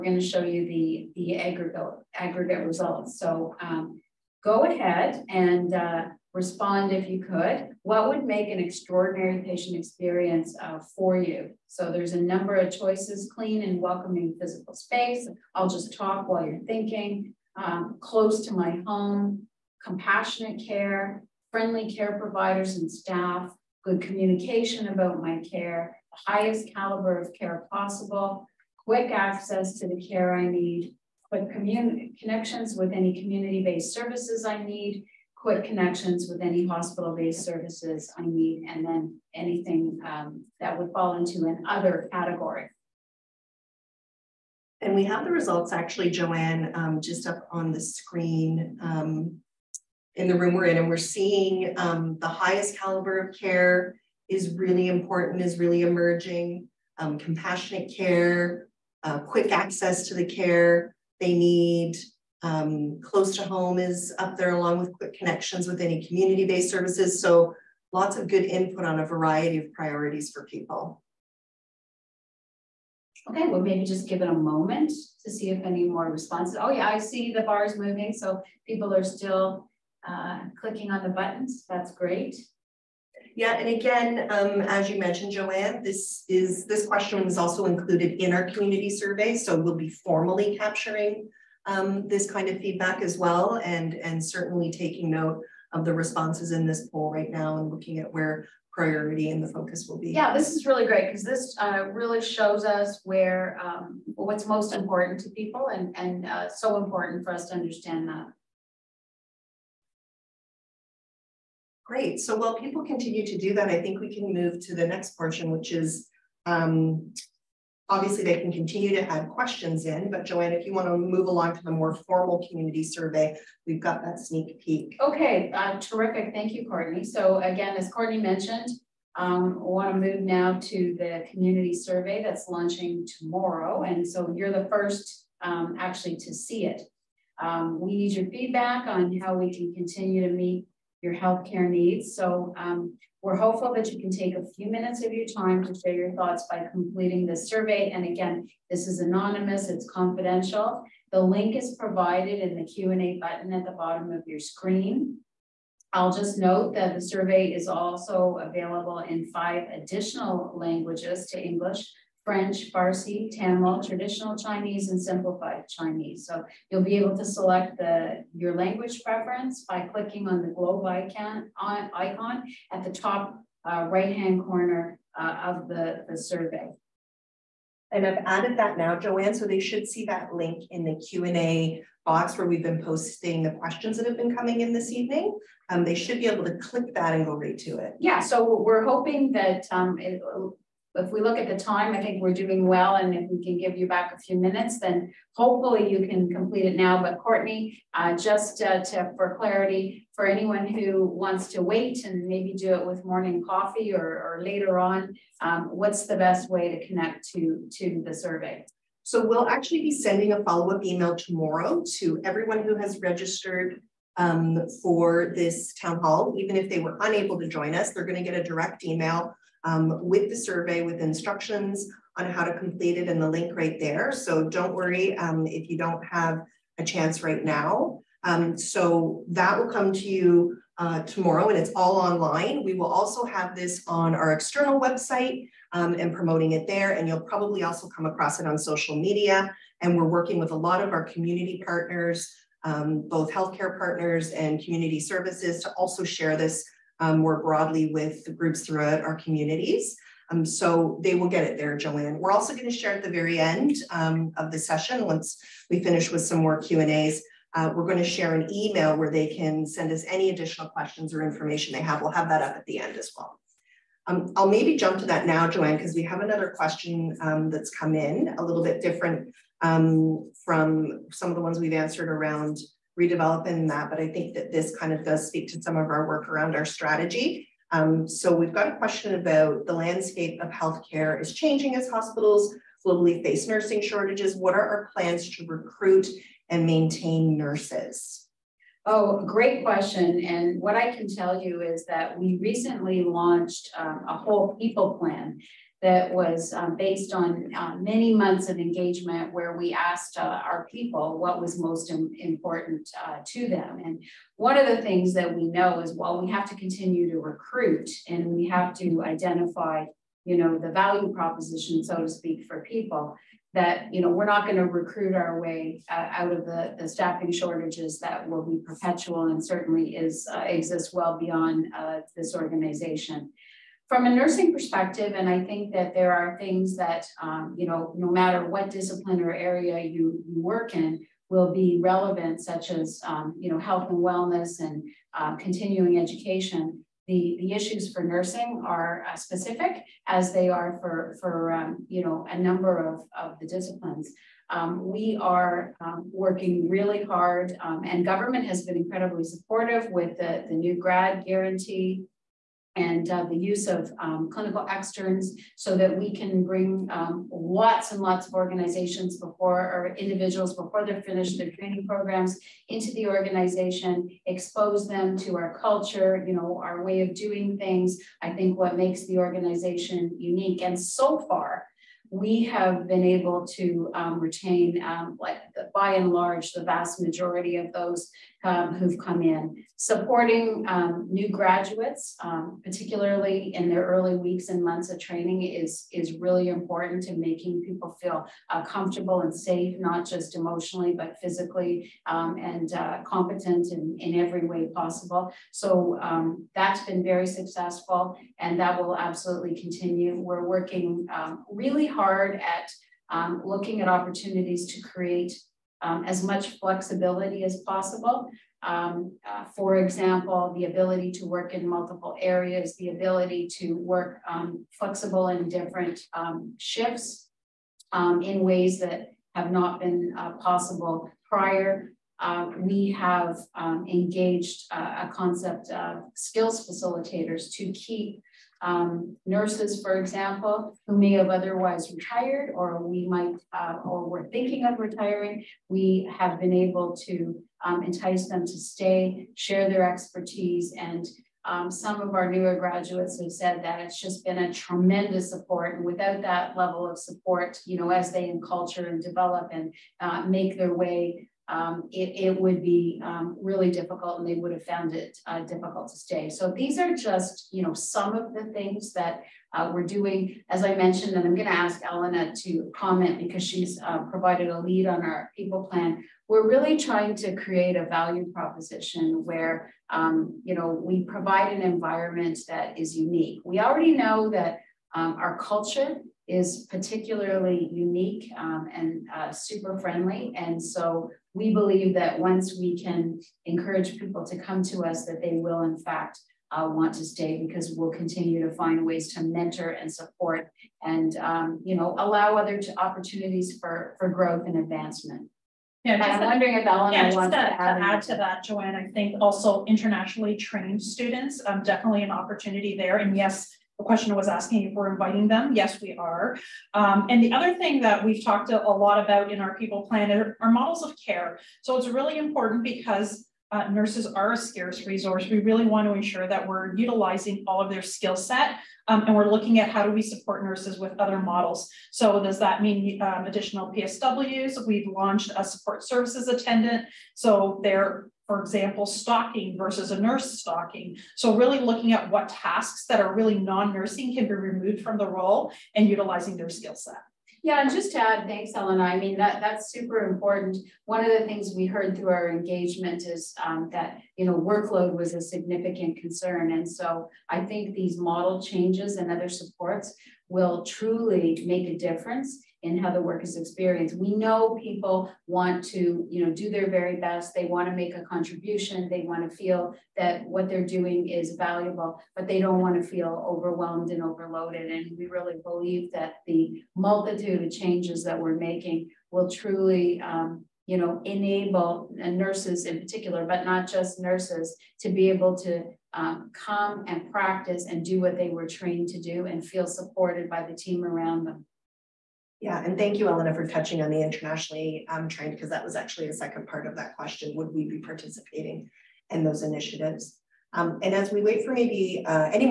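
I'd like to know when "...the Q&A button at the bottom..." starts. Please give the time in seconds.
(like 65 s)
152 s.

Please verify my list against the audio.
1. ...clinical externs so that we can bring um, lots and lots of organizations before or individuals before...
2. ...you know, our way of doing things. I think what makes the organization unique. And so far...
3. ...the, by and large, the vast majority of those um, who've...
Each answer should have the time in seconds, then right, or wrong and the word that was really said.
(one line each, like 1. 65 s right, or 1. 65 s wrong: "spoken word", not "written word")
1. 354 s right
2. 366 s right
3. 375 s right.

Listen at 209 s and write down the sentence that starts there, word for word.
So we'll actually be sending a follow-up email tomorrow to everyone who has registered um, for this town hall.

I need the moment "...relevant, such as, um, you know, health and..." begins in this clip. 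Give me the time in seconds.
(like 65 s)
331 s.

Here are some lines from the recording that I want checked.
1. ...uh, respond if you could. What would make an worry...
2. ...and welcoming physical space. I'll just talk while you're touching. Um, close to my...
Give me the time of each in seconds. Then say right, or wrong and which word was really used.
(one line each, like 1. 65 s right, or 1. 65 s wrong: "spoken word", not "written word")
1. 5 s wrong: "extraordinary", not "worry"
2. 13 s wrong: "thinking", not "touching".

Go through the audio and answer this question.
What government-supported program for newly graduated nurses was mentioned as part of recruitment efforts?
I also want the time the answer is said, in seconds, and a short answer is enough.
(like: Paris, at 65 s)
New grad guarantee, at 350 s.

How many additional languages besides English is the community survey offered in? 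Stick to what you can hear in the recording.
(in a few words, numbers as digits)
5.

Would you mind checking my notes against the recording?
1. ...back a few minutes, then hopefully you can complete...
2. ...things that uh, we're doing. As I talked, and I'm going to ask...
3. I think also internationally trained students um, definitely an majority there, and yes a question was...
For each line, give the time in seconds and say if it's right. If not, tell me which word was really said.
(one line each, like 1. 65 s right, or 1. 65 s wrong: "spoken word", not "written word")
1. 193 s right
2. 458 s wrong: "mentioned", not "talked"
3. 498 s wrong: "opportunity", not "majority".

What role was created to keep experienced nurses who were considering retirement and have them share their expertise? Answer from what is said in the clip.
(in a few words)
Skills facilitators.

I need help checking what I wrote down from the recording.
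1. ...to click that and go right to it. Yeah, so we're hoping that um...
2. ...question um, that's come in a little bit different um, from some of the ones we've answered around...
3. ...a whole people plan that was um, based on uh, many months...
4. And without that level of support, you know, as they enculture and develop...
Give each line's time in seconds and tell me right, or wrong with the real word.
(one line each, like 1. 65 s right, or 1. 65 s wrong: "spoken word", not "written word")
1. 186 s right
2. 266 s right
3. 294 s right
4. 445 s right.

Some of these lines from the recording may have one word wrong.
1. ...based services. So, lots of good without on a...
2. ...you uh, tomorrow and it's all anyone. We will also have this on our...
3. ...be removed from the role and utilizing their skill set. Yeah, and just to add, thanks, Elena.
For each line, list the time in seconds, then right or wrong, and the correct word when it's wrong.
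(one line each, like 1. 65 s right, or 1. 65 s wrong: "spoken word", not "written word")
1. 66 s wrong: "input", not "without"
2. 230 s wrong: "online", not "anyone"
3. 534 s right.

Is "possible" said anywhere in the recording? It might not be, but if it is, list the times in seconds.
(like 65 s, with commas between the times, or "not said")
27 s, 394 s, 407 s, 420 s.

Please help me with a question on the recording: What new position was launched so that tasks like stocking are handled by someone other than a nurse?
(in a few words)
Support services attendant.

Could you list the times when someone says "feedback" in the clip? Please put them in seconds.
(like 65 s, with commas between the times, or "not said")
92 s, 138 s.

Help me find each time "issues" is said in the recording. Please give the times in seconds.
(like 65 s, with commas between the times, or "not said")
337 s.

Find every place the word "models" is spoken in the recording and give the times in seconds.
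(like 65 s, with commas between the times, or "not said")
510 s, 521 s, 547 s.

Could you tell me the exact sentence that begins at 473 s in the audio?
We already know that um, our culture is particularly unique um, and uh, super friendly.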